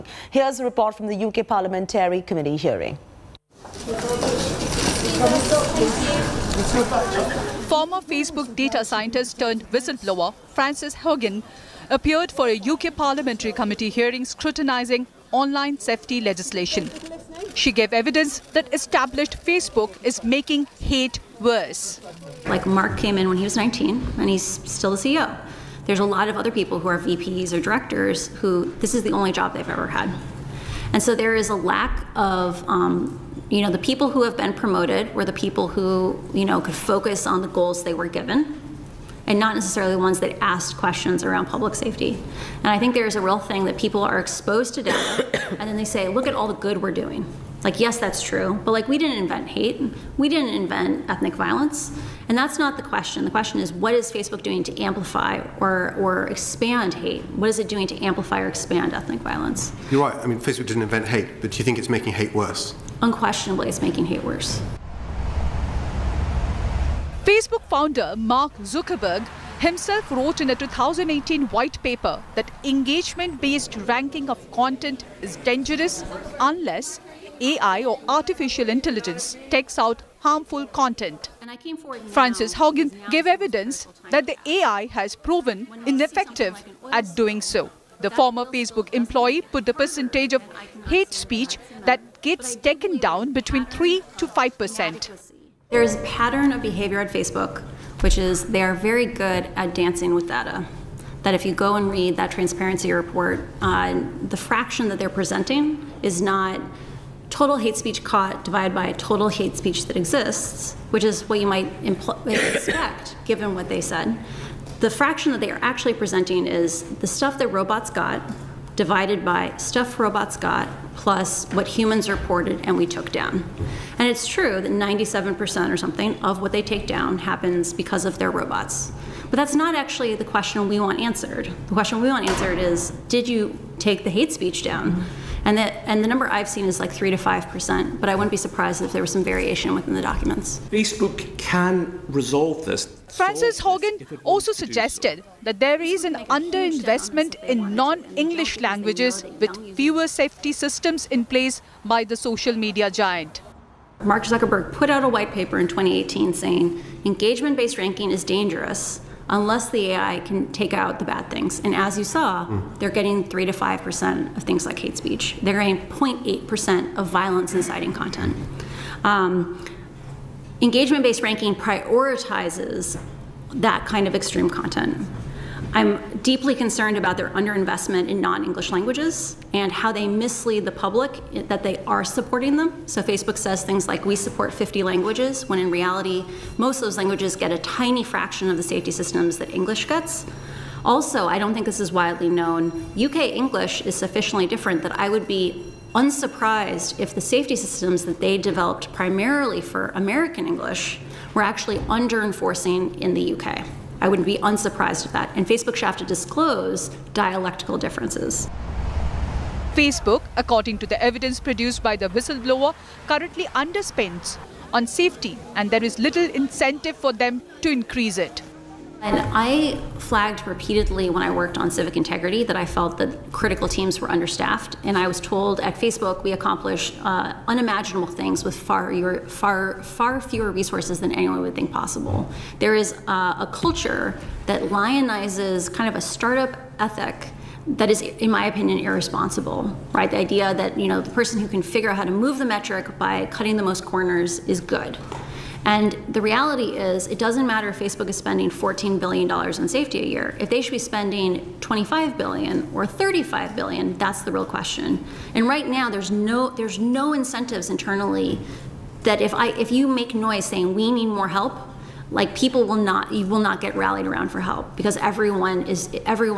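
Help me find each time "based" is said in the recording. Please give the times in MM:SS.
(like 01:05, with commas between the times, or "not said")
01:13, 02:37, 02:50.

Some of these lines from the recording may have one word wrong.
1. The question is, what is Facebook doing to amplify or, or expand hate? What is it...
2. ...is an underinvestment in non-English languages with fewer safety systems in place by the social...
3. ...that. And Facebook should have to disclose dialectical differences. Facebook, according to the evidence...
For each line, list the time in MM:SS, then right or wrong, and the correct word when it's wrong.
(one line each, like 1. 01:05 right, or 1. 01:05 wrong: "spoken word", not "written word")
1. 00:53 right
2. 02:25 right
3. 03:25 right.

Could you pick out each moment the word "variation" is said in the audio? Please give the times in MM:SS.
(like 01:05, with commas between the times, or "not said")
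02:19.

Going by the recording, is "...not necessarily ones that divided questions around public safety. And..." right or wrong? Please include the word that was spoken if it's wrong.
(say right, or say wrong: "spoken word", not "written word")
wrong: "asked", not "divided".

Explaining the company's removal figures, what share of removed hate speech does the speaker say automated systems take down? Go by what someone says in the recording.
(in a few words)
97%.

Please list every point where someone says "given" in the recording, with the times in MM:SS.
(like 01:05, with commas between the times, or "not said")
00:38, 01:53.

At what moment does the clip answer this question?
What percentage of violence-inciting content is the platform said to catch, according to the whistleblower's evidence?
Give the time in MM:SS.
02:45.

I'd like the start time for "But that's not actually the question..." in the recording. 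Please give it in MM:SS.
02:09.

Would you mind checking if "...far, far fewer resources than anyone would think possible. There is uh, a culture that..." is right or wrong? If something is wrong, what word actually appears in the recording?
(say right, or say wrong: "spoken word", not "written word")
right.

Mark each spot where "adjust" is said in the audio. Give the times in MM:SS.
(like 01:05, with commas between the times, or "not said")
not said.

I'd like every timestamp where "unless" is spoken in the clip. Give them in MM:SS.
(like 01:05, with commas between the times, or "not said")
01:16, 02:39.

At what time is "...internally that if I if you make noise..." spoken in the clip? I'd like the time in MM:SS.
04:17.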